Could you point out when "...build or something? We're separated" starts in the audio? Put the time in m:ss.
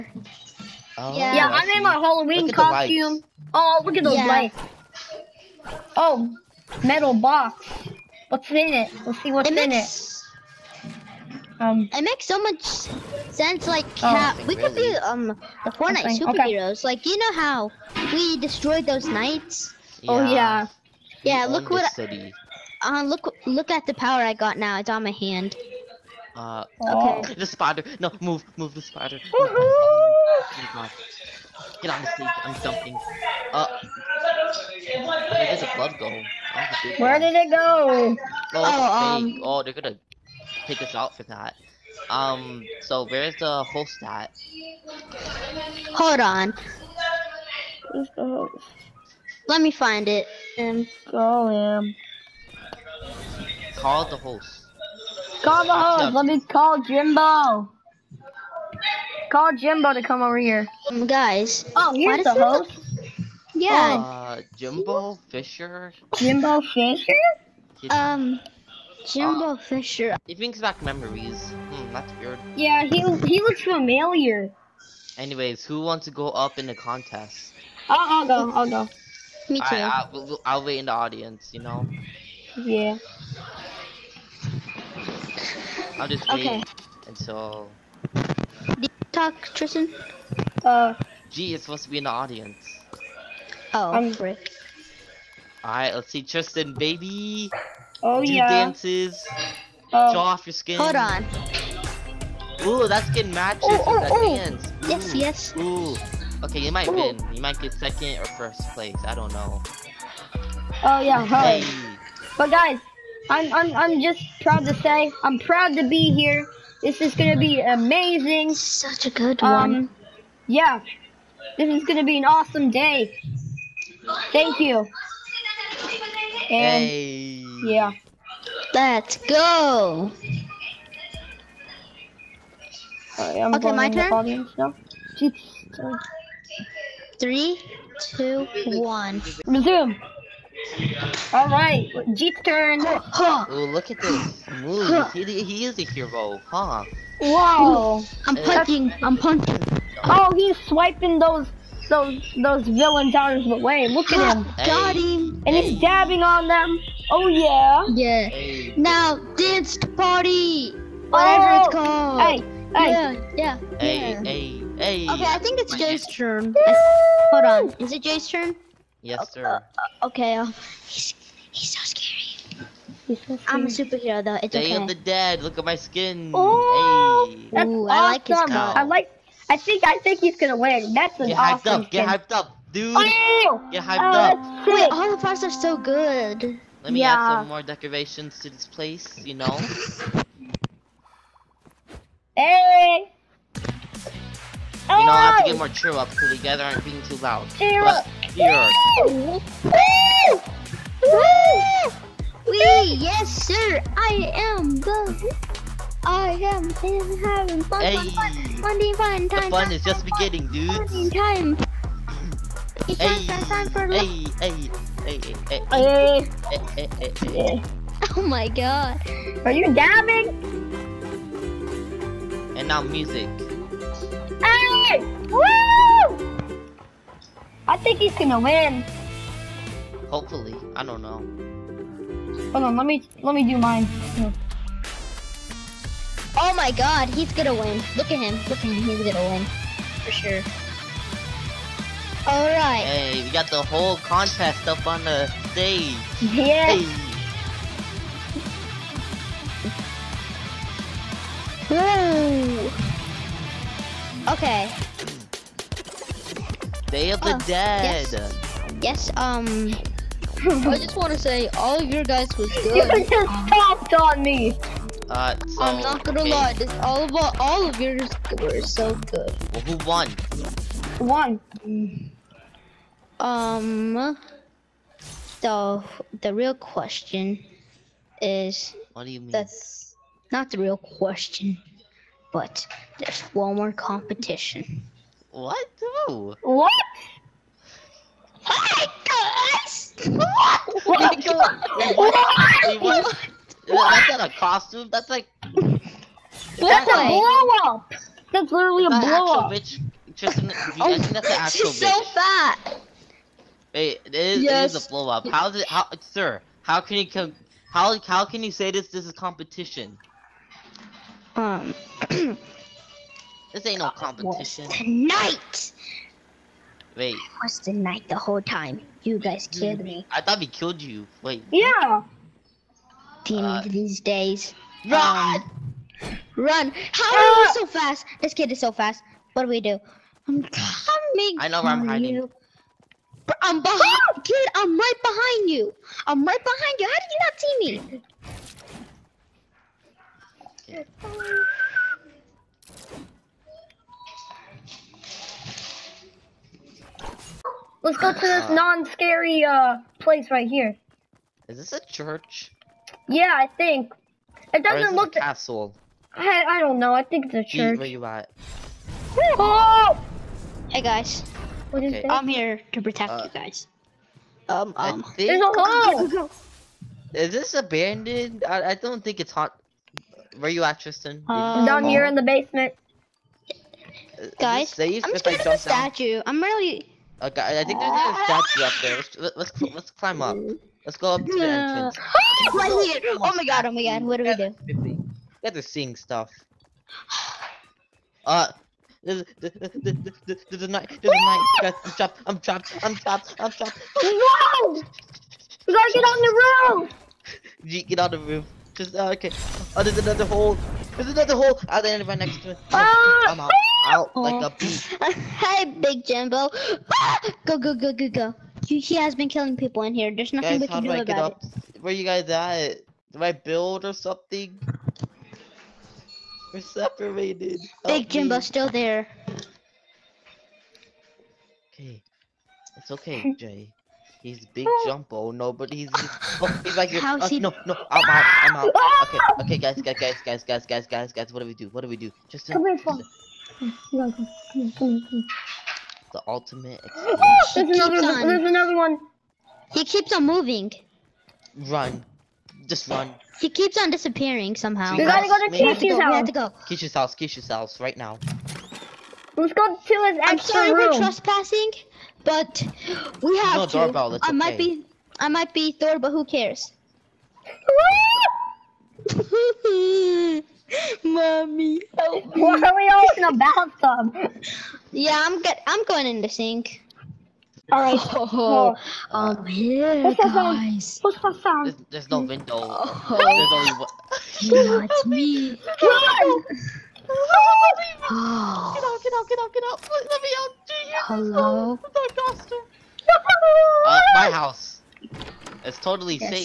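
6:53.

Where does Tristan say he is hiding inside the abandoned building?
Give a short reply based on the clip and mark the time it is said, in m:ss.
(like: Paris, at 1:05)
the basement, at 6:11.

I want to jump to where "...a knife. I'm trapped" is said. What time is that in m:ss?
6:31.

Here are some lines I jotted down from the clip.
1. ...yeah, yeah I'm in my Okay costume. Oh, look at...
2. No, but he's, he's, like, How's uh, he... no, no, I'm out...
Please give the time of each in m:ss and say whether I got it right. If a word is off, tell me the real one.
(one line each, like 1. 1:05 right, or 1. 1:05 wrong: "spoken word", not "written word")
1. 0:01 wrong: "Halloween", not "Okay"
2. 7:05 right.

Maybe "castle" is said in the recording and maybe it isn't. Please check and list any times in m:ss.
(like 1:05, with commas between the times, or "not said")
5:55.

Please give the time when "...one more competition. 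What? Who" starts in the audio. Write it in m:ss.
4:43.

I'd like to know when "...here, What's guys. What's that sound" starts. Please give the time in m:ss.
7:49.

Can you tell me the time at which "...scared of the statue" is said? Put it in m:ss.
6:15.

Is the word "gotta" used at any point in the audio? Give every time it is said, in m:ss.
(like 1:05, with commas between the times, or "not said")
6:35, 7:25.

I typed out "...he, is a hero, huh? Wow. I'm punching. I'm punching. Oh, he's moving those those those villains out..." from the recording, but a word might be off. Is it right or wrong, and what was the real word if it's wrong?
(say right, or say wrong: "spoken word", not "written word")
wrong: "swiping", not "moving".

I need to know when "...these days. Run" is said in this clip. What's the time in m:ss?
5:23.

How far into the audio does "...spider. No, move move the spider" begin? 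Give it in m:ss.
0:27.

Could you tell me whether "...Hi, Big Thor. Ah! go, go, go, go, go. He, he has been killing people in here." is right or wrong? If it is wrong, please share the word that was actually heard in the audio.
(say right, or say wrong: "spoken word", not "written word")
wrong: "Jimbo", not "Thor".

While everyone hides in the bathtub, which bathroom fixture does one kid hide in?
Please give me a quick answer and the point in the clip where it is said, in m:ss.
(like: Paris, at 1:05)
the sink, at 7:46.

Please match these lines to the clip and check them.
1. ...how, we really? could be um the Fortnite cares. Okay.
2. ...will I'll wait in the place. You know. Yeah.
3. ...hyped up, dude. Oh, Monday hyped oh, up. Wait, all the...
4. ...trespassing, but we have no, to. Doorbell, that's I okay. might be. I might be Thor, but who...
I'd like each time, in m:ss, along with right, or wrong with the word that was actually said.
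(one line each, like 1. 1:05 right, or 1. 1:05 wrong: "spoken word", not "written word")
1. 0:14 wrong: "superheroes", not "cares"
2. 1:20 wrong: "audience", not "place"
3. 3:02 wrong: "Get", not "Monday"
4. 7:30 right.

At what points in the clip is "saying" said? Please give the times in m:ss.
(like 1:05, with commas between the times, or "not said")
not said.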